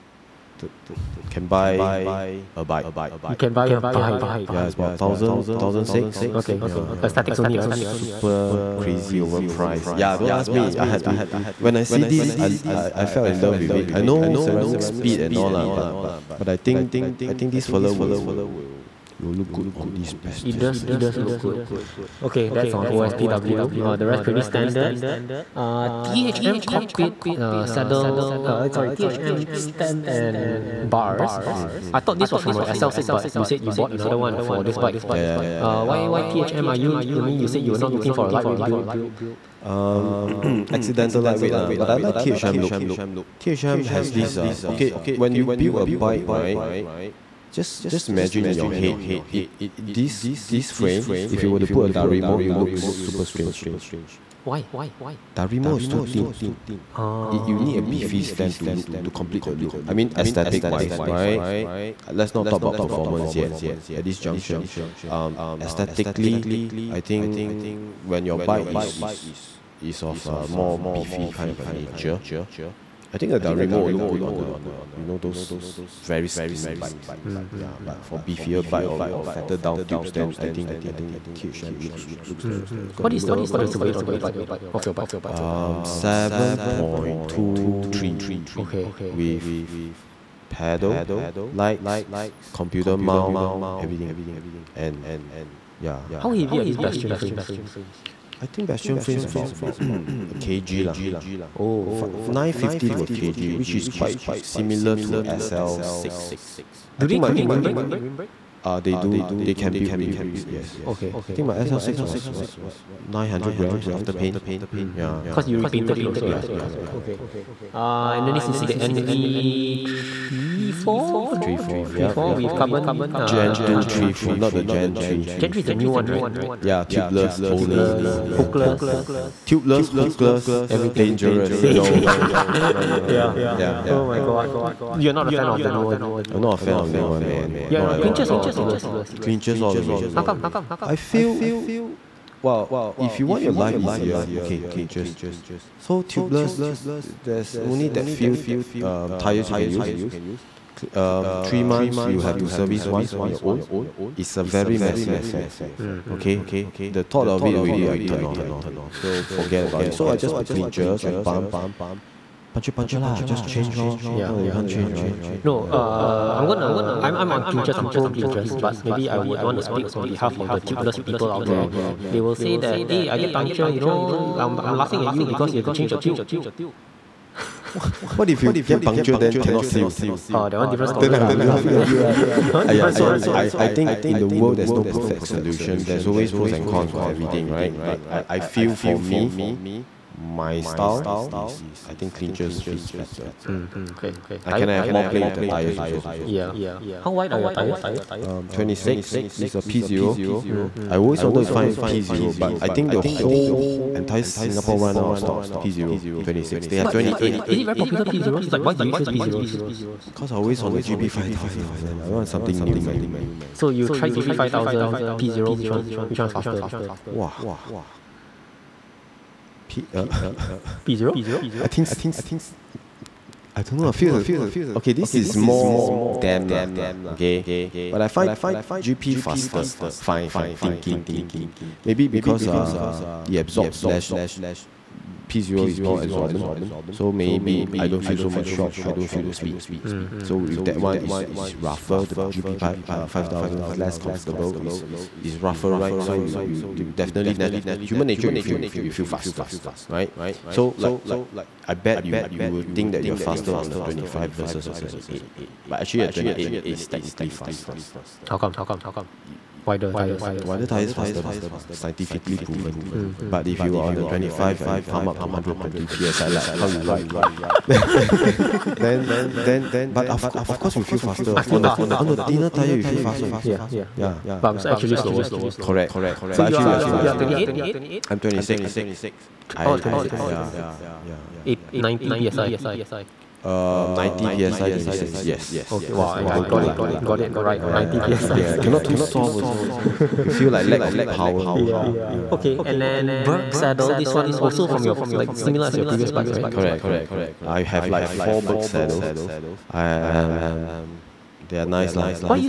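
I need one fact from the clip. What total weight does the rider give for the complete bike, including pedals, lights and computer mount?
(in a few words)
7.23 kg.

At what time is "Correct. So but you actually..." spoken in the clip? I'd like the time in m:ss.
4:35.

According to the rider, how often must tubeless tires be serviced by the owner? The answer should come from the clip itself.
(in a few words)
Every 3 months.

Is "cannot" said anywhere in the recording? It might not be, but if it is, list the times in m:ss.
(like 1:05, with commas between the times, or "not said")
2:59, 4:48.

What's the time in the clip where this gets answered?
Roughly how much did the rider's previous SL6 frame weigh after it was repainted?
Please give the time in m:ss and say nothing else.
1:53.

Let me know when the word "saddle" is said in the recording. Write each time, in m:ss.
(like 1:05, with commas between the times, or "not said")
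0:27, 4:53, 4:58.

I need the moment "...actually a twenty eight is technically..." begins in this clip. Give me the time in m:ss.
4:15.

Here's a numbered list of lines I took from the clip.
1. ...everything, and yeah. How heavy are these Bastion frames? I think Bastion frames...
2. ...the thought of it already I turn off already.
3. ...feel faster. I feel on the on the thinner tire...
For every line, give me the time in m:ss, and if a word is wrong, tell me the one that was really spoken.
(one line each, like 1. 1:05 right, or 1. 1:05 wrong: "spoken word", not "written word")
1. 1:33 right
2. 2:36 right
3. 4:30 right.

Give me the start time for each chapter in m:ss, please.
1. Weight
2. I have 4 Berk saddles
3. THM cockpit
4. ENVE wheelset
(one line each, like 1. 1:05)
1. 1:24
2. 4:52
3. 0:25
4. 2:01.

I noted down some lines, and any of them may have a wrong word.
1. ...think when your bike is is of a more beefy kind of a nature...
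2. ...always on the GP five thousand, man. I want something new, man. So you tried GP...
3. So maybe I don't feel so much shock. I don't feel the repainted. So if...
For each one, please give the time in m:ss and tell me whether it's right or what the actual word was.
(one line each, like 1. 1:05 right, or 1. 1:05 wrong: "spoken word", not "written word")
1. 1:06 right
2. 3:30 right
3. 3:56 wrong: "speed", not "repainted".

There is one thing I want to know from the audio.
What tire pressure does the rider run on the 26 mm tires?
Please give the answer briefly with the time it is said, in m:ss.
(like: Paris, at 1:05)
90 psi, at 4:43.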